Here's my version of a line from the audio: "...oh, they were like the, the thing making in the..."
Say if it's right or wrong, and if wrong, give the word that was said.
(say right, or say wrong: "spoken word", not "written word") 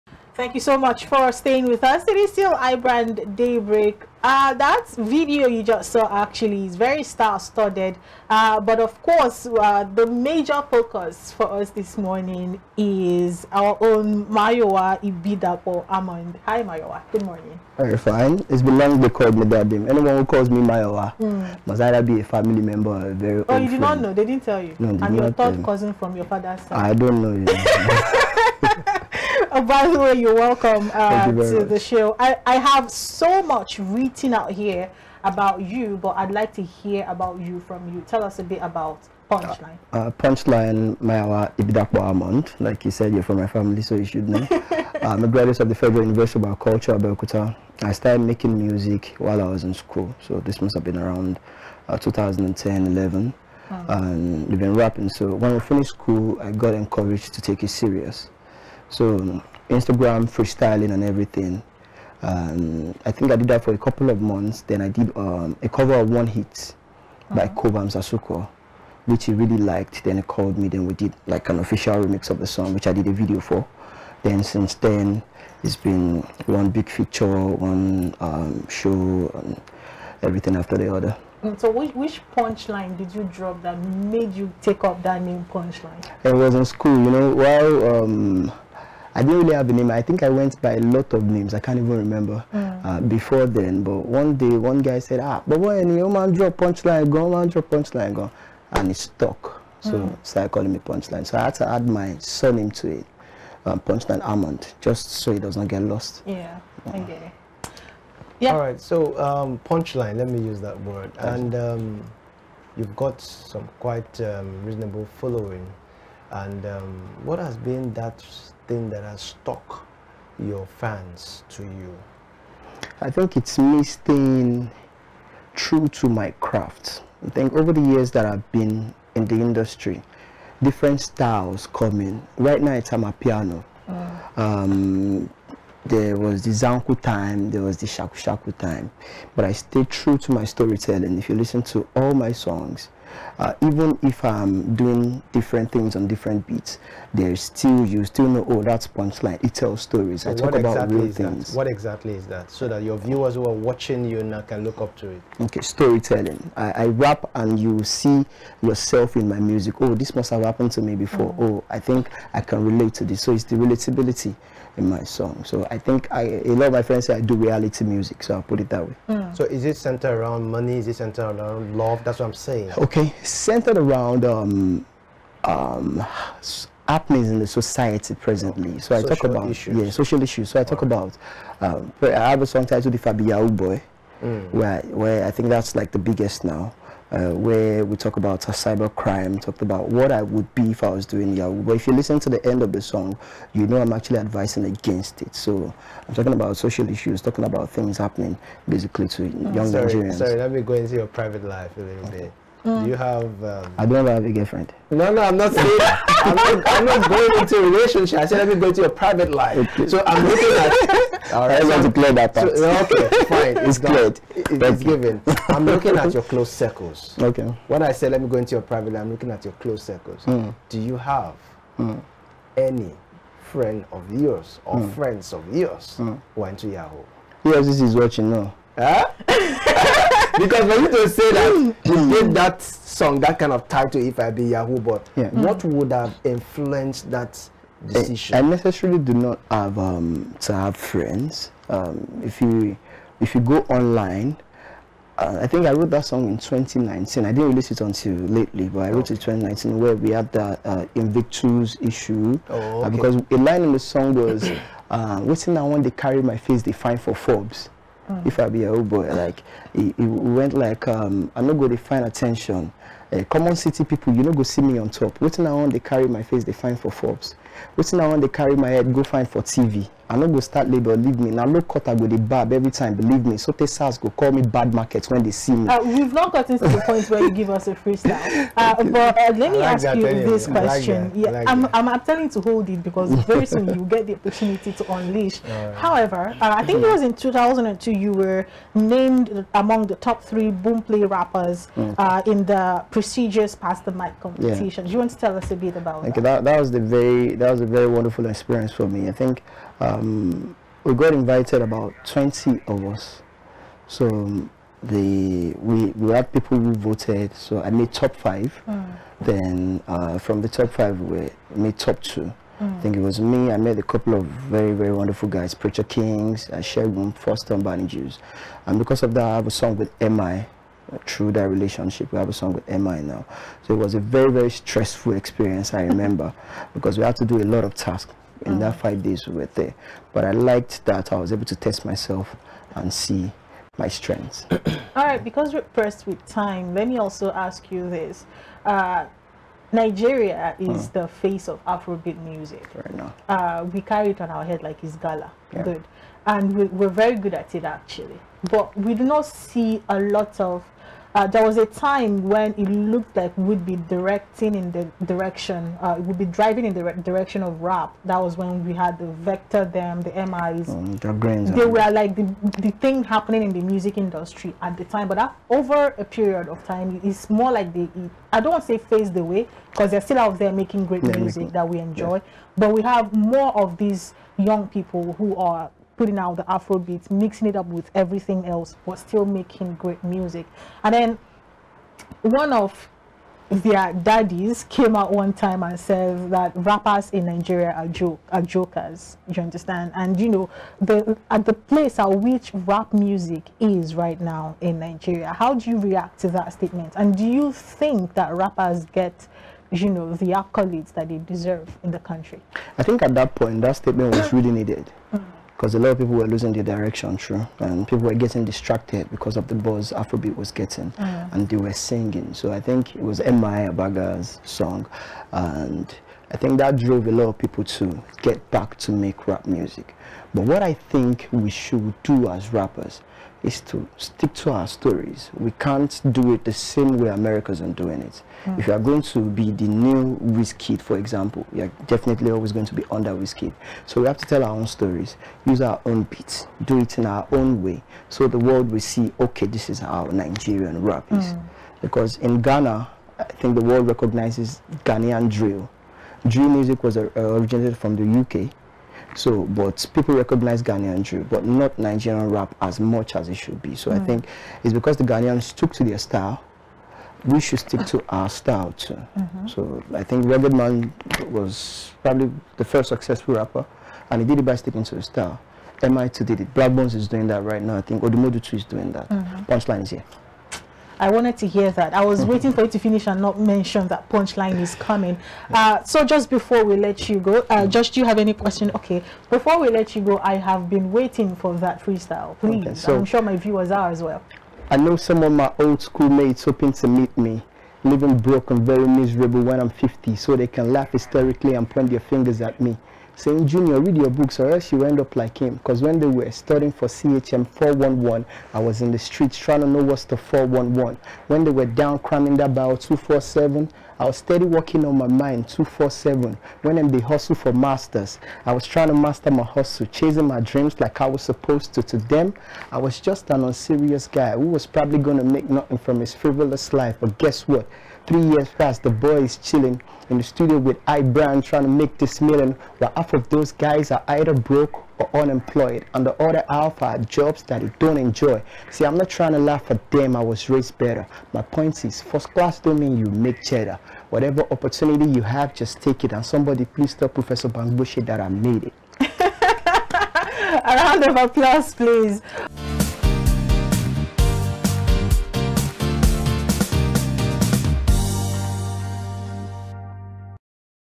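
wrong: "happening", not "making".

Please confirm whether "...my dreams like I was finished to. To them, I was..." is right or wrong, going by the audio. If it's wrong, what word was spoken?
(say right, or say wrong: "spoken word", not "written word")
wrong: "supposed", not "finished".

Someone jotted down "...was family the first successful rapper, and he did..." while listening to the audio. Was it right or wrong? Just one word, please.
wrong.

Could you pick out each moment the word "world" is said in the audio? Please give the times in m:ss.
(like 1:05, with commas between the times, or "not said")
7:18, 7:23.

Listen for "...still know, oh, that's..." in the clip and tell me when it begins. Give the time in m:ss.
2:28.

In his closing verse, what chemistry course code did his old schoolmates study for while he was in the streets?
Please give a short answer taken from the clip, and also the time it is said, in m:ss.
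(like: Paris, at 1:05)
CHM 411, at 8:16.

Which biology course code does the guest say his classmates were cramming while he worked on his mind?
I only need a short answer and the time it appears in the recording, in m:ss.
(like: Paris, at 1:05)
Bio 247, at 8:22.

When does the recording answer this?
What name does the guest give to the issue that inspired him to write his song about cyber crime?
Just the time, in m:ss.
4:10.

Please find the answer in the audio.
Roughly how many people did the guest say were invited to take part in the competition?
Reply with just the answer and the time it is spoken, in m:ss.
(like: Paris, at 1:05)
20, at 5:02.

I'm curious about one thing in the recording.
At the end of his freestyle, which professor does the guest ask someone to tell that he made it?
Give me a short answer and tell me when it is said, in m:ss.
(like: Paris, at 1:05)
Professor Bangbushi, at 8:57.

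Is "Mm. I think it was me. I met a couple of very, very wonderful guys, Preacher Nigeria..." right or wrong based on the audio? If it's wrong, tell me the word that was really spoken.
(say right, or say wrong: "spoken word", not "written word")
wrong: "Kings", not "Nigeria".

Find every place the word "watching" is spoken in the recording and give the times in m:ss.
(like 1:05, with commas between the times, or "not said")
2:33, 3:47.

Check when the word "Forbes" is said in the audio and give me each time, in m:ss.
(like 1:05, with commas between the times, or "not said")
4:17, 4:26.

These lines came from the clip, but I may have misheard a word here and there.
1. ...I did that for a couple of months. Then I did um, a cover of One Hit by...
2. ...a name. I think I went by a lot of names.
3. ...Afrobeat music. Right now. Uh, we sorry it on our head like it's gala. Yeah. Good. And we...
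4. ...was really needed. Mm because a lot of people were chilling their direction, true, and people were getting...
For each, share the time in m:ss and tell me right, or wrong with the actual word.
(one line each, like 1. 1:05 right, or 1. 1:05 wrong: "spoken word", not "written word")
1. 1:03 right
2. 1:29 right
3. 5:41 wrong: "carry", not "sorry"
4. 6:44 wrong: "losing", not "chilling".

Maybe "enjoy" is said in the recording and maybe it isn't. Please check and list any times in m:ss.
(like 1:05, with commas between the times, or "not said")
6:11, 8:47.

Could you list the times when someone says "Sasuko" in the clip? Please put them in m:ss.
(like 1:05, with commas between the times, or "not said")
1:07.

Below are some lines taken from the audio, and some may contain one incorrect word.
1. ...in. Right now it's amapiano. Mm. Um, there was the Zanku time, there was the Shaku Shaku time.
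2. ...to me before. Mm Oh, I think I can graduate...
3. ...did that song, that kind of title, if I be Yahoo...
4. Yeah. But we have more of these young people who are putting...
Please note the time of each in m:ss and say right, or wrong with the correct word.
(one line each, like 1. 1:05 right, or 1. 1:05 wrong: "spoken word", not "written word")
1. 2:12 right
2. 2:40 wrong: "relate", not "graduate"
3. 3:52 right
4. 6:12 right.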